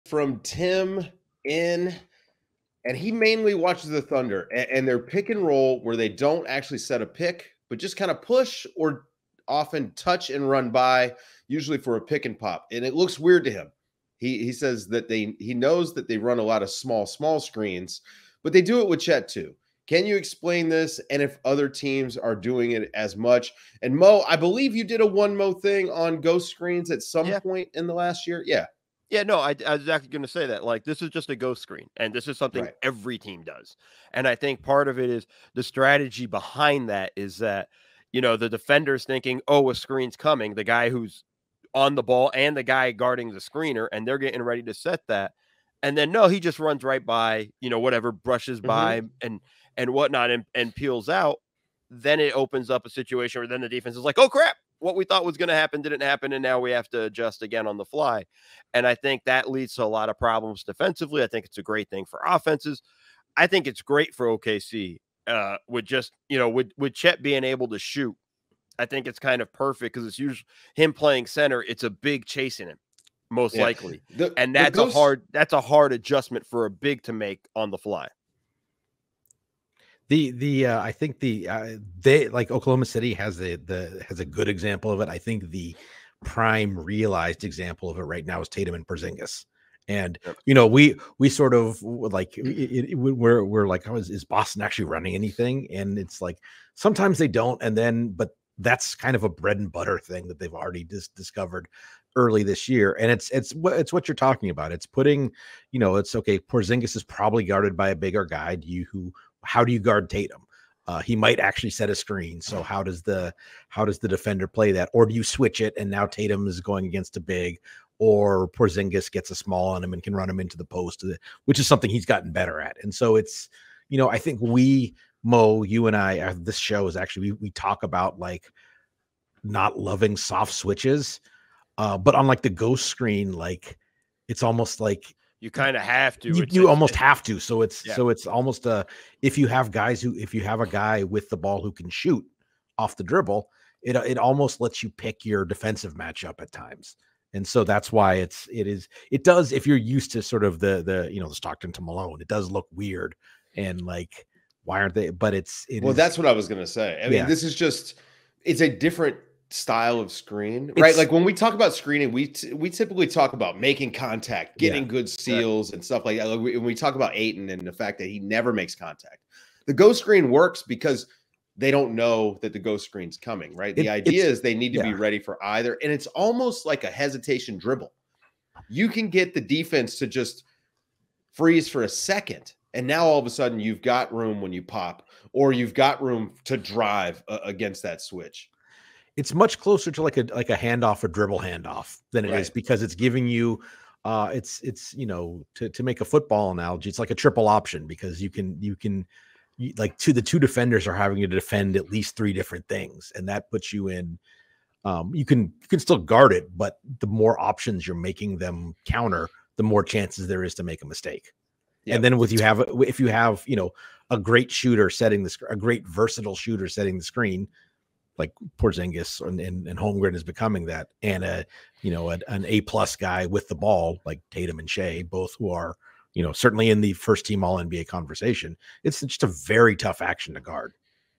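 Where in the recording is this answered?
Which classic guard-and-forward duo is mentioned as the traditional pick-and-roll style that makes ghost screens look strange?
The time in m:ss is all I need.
2:31.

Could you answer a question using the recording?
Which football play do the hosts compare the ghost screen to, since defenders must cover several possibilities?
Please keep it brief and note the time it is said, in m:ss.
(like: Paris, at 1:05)
Triple option, at 3:17.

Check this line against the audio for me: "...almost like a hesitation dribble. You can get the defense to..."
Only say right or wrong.
right.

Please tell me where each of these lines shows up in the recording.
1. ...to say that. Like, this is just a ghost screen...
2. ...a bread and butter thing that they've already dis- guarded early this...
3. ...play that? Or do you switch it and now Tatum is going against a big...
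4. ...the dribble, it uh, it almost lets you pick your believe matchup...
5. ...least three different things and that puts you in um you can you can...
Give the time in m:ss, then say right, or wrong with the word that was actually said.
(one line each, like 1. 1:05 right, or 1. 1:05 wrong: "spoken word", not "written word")
1. 0:30 right
2. 1:39 wrong: "discovered", not "guarded"
3. 1:54 right
4. 2:22 wrong: "defensive", not "believe"
5. 3:21 right.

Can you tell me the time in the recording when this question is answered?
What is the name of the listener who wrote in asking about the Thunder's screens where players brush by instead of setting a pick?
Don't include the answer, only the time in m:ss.
0:00.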